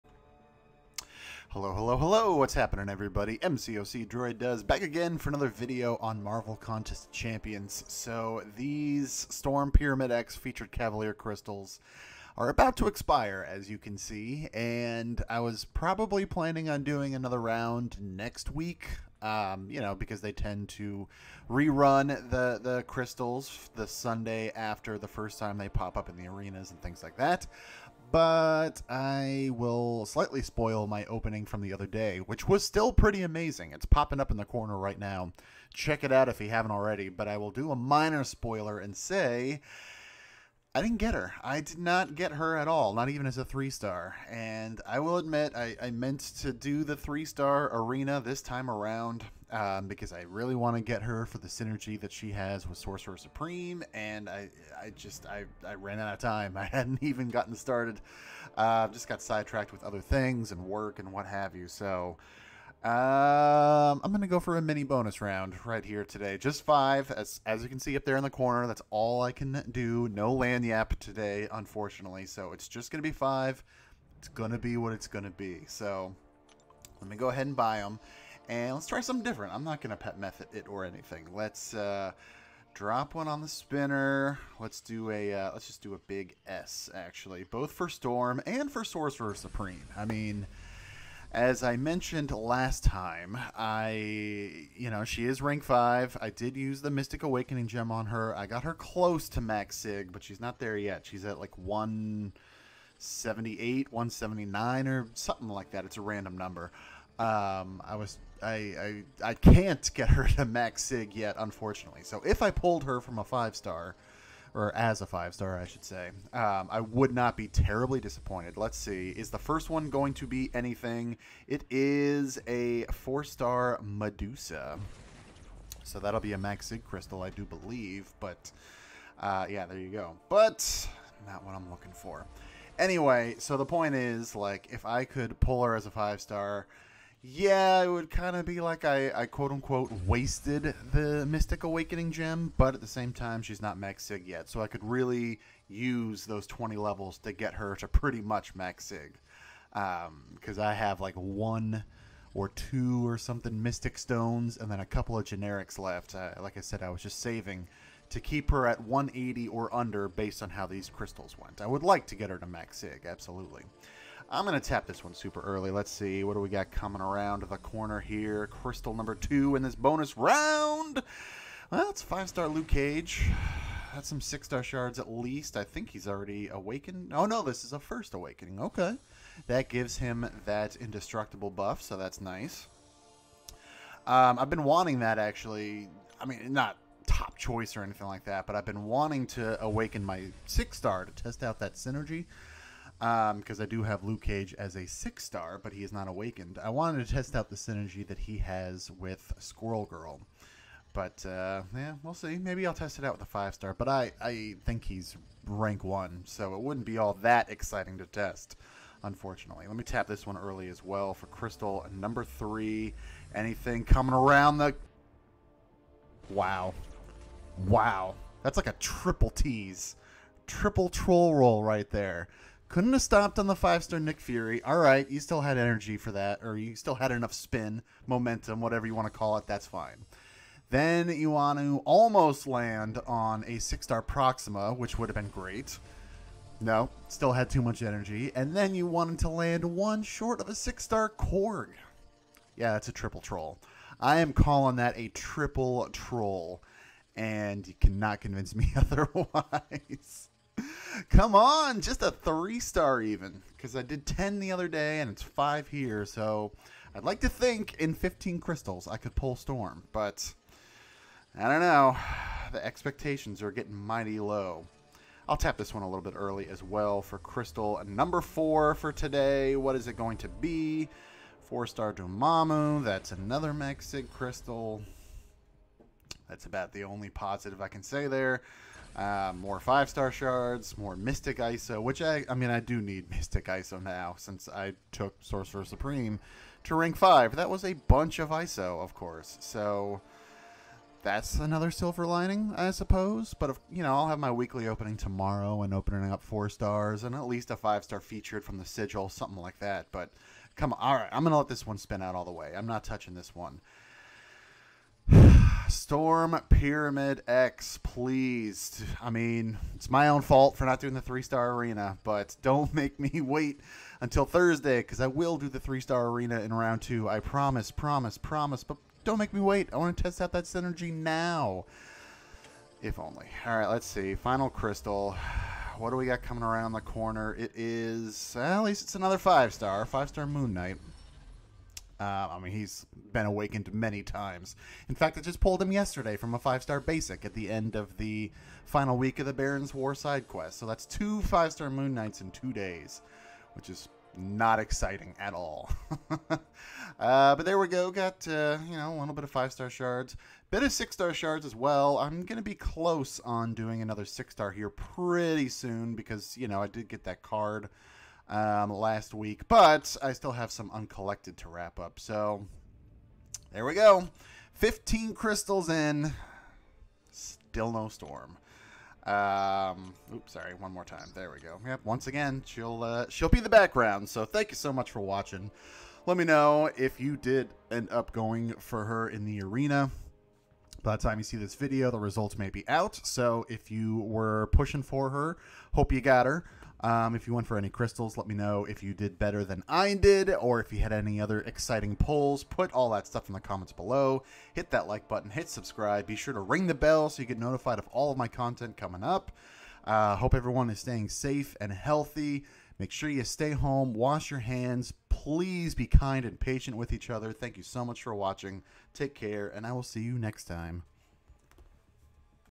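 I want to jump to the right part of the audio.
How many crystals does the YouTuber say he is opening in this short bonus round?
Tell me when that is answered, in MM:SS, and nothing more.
01:06.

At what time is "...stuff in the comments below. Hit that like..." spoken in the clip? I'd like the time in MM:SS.
06:33.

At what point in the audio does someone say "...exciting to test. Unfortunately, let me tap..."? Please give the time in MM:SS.
03:27.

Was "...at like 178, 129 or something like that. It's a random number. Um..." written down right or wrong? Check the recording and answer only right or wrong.
wrong.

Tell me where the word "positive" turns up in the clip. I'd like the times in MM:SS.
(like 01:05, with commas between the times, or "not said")
04:37.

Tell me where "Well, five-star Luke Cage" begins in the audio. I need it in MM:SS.
02:51.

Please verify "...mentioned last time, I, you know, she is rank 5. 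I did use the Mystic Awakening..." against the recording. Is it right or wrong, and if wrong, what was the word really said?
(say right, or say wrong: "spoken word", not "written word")
right.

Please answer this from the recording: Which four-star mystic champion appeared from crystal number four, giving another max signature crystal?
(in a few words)
Dormammu.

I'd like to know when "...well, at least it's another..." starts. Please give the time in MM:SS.
05:28.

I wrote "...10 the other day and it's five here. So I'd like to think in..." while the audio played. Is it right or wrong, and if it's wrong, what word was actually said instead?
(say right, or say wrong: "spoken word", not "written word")
right.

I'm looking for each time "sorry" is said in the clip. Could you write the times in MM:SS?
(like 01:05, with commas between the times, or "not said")
06:10.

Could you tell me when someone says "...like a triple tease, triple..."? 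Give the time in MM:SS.
03:38.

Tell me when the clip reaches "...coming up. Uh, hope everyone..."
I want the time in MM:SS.
06:38.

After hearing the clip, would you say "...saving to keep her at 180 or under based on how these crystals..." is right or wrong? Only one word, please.
right.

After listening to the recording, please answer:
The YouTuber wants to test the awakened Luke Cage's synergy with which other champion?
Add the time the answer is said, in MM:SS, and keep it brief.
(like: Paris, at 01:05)
Squirrel Girl, at 03:19.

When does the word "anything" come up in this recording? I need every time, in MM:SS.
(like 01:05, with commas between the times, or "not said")
01:20, 02:00, 03:07, 03:33.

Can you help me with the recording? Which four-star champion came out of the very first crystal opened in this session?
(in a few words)
Medusa.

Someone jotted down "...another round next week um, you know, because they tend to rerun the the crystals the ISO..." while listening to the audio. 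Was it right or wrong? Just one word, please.
wrong.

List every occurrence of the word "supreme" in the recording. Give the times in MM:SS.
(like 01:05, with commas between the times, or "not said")
00:53, 01:29, 04:45.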